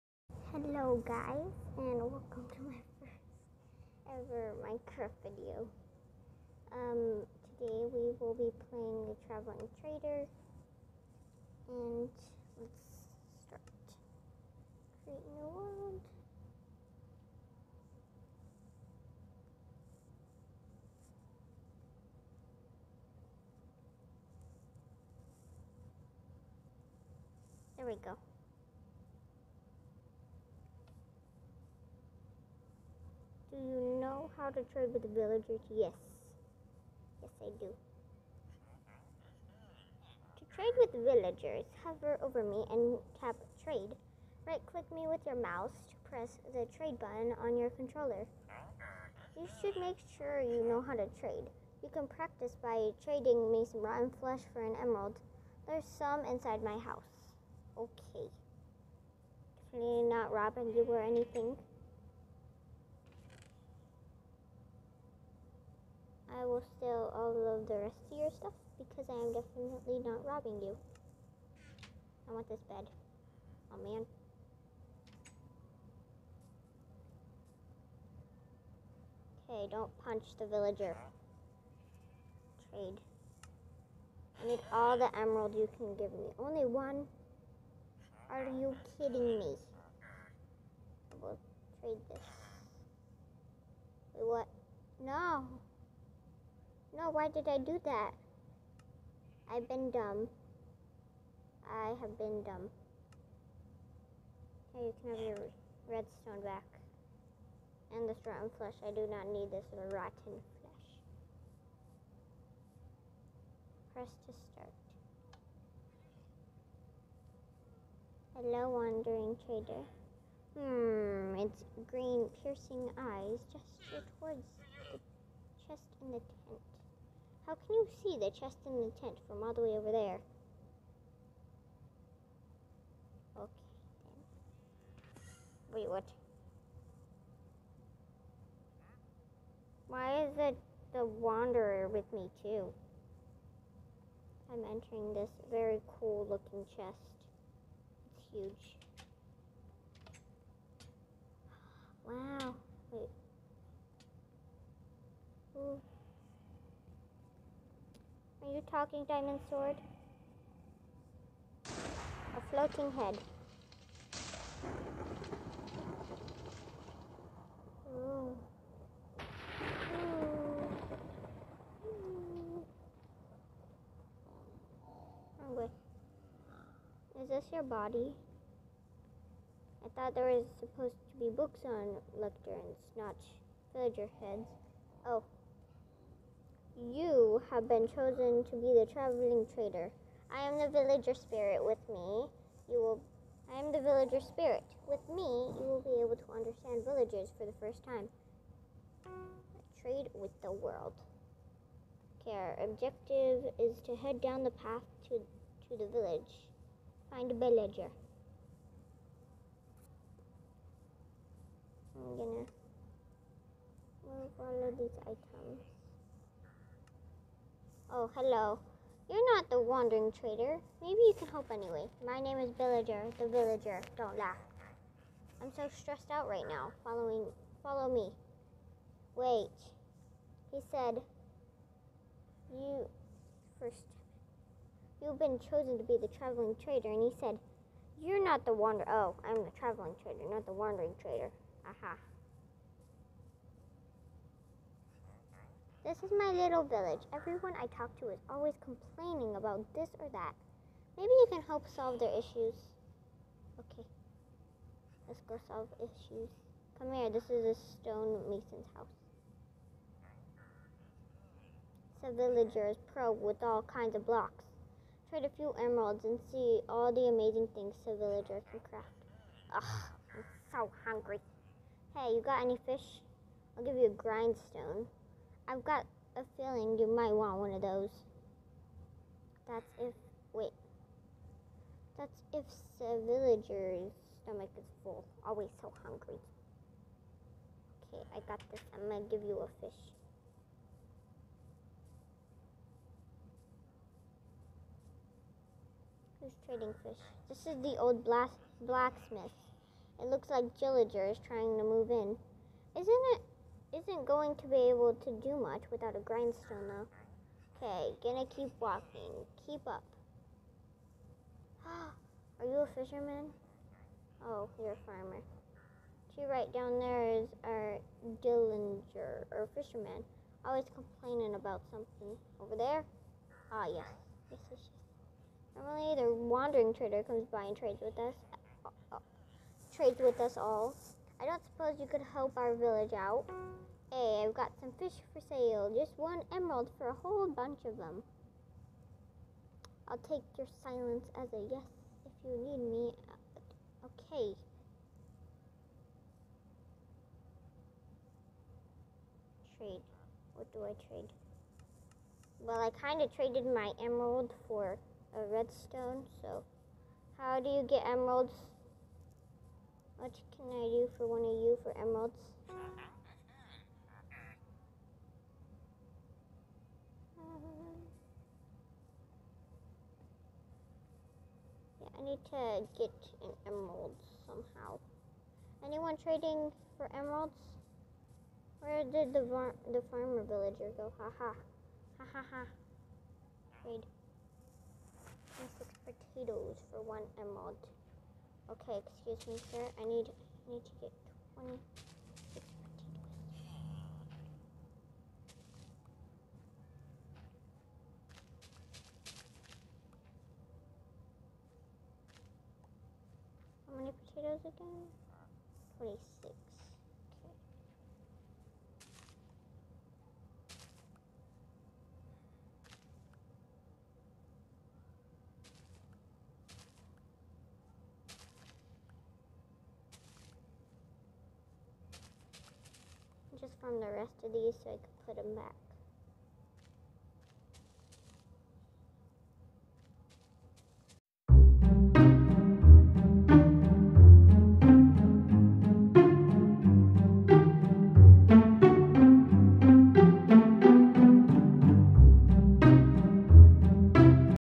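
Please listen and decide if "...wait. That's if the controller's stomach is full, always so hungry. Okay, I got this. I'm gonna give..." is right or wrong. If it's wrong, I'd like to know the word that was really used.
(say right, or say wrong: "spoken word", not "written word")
wrong: "villager", not "controller".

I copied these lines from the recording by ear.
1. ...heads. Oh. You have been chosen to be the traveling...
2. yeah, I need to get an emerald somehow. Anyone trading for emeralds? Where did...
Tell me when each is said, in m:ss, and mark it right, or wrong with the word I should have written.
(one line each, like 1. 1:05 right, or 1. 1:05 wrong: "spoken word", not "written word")
1. 3:04 right
2. 6:11 right.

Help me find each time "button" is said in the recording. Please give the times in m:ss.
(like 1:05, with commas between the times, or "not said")
0:46.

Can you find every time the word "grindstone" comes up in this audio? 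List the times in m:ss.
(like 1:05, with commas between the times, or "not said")
4:34, 5:06.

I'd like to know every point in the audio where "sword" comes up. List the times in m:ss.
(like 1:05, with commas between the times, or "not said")
2:39.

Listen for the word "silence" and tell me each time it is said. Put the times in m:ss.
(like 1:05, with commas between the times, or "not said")
5:40.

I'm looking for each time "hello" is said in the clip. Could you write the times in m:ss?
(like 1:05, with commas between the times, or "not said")
0:00, 1:58, 3:38.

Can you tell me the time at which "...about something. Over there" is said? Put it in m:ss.
5:21.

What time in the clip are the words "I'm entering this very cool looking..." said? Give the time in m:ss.
2:24.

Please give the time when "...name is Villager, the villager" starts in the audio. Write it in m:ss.
3:42.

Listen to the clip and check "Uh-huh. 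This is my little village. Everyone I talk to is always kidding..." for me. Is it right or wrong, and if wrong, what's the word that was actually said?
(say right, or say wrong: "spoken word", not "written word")
wrong: "complaining", not "kidding".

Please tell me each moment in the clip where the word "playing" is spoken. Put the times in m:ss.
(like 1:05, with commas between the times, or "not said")
0:08.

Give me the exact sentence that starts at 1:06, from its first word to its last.
I will steal all of the rest of your stuff because I am definitely not robbing you.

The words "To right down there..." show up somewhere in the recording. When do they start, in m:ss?
5:16.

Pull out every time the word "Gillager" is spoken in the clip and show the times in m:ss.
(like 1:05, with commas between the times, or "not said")
5:00.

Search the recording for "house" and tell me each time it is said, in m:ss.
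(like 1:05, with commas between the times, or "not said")
0:56, 4:18.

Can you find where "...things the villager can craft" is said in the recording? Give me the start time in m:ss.
4:27.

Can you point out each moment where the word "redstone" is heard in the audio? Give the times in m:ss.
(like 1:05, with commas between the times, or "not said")
1:45, 5:55.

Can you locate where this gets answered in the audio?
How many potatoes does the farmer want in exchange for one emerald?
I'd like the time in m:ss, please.
6:25.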